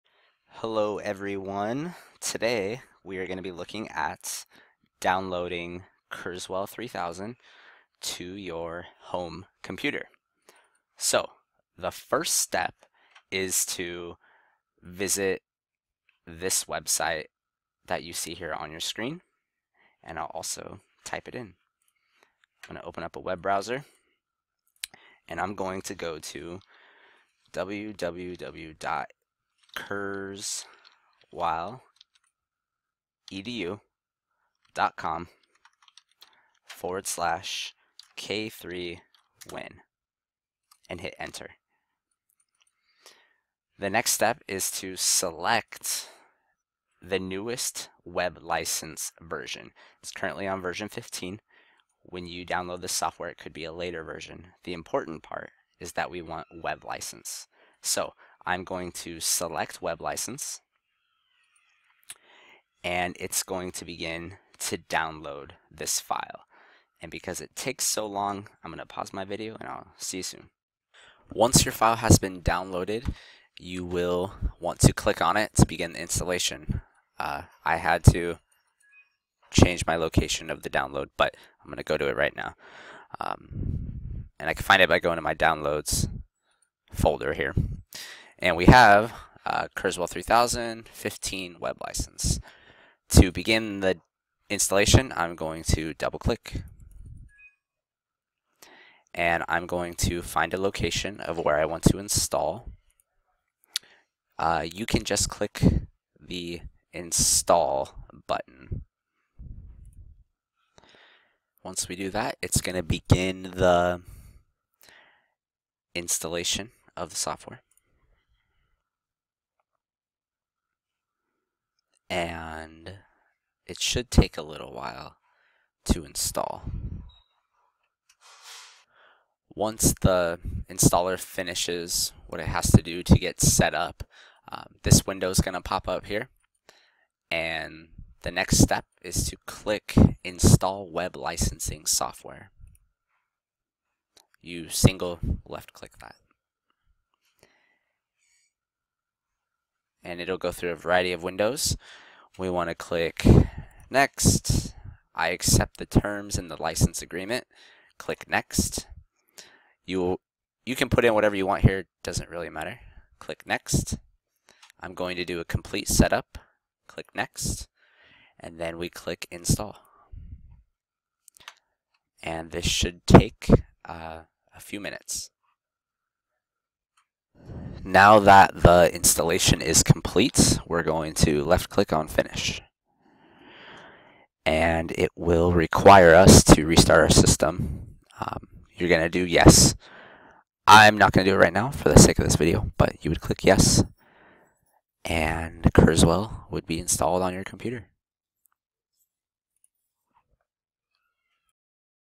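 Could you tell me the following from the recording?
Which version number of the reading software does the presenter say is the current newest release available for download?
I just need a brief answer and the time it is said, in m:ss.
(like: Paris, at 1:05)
15, at 0:50.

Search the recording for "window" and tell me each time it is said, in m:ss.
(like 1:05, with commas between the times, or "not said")
2:15, 2:31.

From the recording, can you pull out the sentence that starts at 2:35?
I accept the terms in the license agreement.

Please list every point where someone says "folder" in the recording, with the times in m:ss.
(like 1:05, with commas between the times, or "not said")
1:26.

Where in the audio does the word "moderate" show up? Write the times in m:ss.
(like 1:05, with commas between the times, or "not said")
not said.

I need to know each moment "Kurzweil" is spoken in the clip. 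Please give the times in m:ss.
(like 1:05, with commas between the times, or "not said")
0:06, 1:29, 3:15.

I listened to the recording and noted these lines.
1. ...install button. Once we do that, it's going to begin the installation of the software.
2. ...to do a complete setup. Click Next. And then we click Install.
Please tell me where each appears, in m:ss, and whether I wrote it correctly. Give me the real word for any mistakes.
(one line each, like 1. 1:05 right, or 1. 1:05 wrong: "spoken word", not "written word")
1. 1:46 right
2. 2:45 right.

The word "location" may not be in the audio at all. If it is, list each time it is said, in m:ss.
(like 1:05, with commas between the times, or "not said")
1:19, 1:40.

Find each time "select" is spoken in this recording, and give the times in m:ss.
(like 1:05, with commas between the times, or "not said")
0:44, 0:59.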